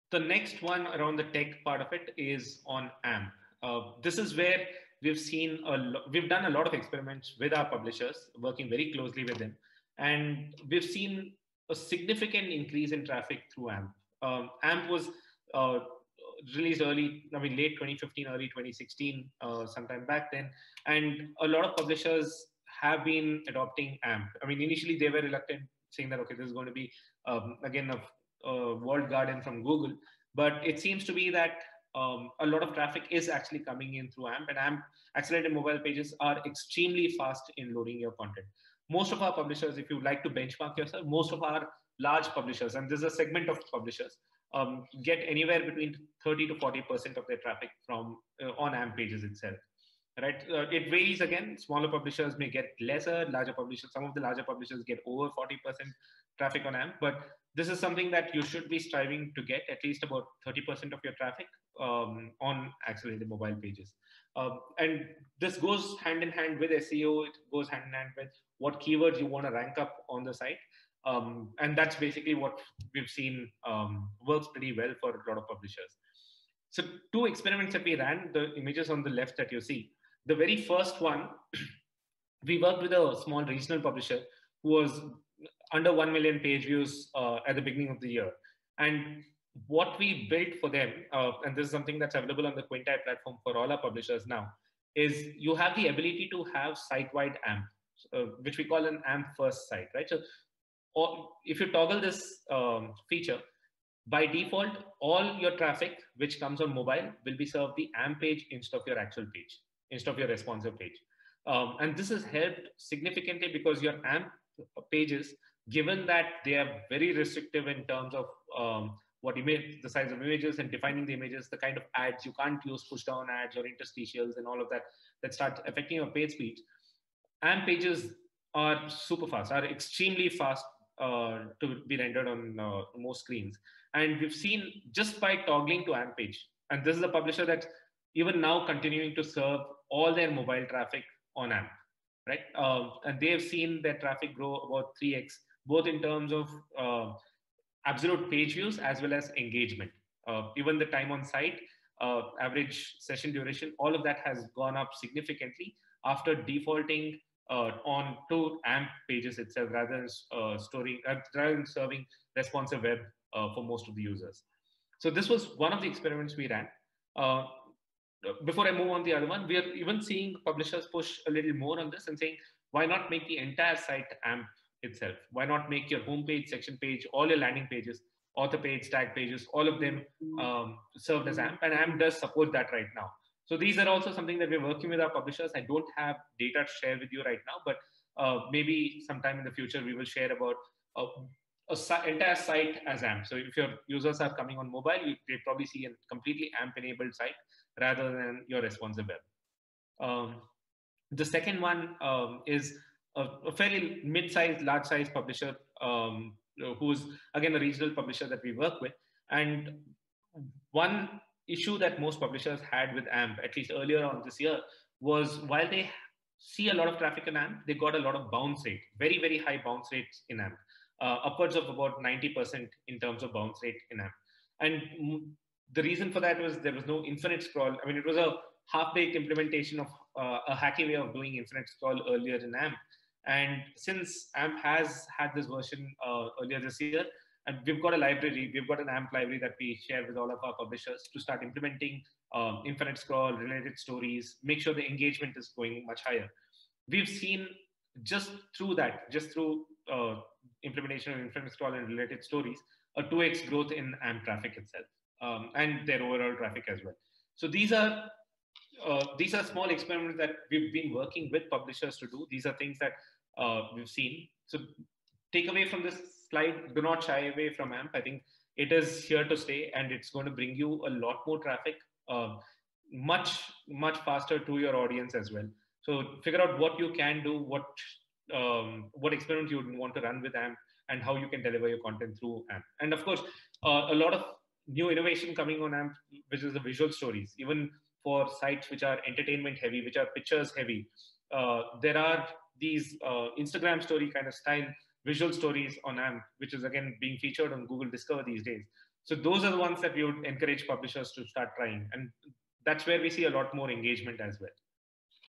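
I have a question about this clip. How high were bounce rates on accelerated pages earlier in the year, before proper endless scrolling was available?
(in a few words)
about 90%.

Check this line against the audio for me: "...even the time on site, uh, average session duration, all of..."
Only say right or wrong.
right.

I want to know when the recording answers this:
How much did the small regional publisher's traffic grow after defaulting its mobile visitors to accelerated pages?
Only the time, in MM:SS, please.
02:25.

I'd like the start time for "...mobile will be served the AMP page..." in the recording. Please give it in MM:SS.
01:46.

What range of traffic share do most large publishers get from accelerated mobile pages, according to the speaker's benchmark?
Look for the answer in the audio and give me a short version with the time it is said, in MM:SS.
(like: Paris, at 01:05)
30 to 40%, at 00:46.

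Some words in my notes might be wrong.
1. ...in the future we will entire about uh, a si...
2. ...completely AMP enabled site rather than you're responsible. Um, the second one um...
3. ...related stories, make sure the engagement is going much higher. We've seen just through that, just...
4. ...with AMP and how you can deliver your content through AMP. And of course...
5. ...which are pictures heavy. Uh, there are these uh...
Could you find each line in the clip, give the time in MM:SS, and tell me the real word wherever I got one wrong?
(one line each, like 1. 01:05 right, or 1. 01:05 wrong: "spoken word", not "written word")
1. 03:09 wrong: "share", not "entire"
2. 03:16 right
3. 04:03 right
4. 04:40 right
5. 04:49 right.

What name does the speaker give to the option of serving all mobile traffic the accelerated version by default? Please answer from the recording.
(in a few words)
AMP first site.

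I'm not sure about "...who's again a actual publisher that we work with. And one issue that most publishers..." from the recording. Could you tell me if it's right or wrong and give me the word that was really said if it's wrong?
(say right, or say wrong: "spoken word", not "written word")
wrong: "regional", not "actual".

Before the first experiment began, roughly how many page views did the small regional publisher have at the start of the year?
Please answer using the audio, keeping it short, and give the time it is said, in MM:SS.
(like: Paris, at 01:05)
under 1 million, at 01:25.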